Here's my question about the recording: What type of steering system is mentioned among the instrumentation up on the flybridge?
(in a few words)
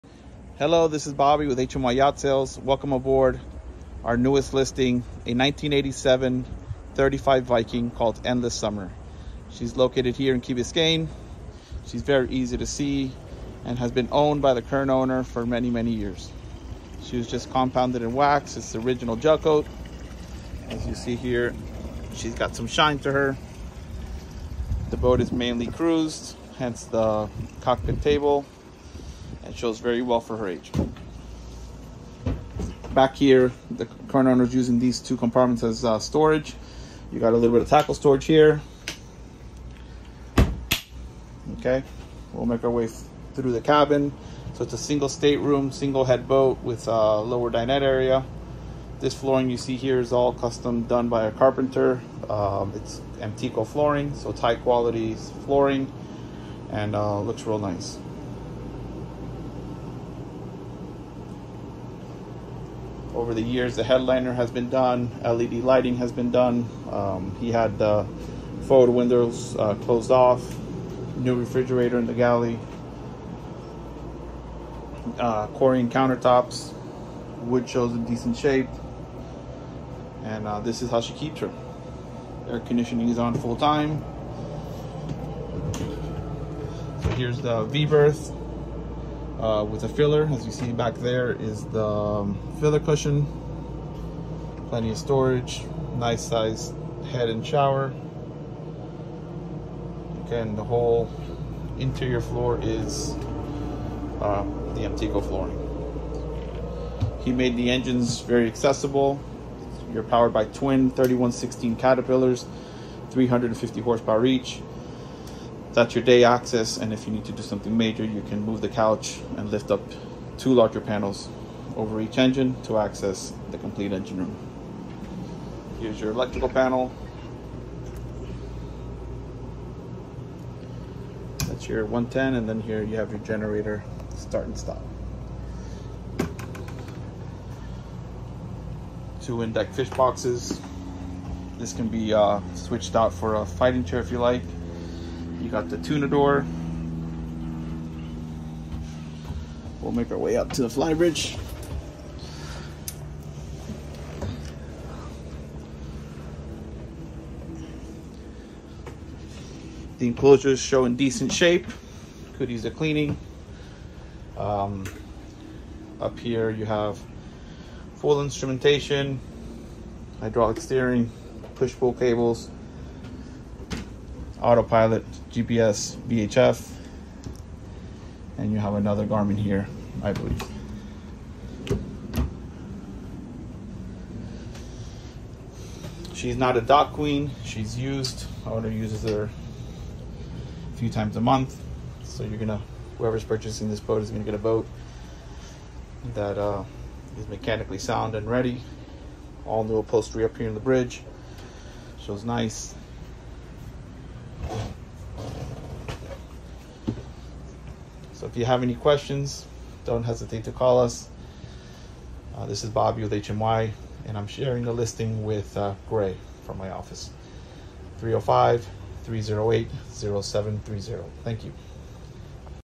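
hydraulic steering.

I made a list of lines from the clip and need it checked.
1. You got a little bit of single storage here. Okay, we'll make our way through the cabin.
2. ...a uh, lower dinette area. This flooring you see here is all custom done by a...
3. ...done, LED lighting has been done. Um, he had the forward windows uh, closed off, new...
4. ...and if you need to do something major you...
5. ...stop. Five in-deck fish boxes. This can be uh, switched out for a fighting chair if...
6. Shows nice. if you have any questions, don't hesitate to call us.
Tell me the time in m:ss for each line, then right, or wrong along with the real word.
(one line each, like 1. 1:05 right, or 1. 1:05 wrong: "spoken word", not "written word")
1. 0:37 wrong: "tackle", not "single"
2. 0:46 right
3. 1:04 right
4. 1:56 right
5. 2:14 wrong: "Two", not "Five"
6. 3:22 right.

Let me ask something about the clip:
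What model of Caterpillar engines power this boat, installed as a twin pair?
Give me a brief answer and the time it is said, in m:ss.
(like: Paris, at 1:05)
3116, at 1:50.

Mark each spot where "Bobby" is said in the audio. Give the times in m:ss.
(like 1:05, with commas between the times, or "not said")
0:01, 3:32.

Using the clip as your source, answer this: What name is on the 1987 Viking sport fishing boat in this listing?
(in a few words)
Endless Summer.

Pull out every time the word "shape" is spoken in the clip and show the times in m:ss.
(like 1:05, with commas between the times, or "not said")
1:18, 2:41.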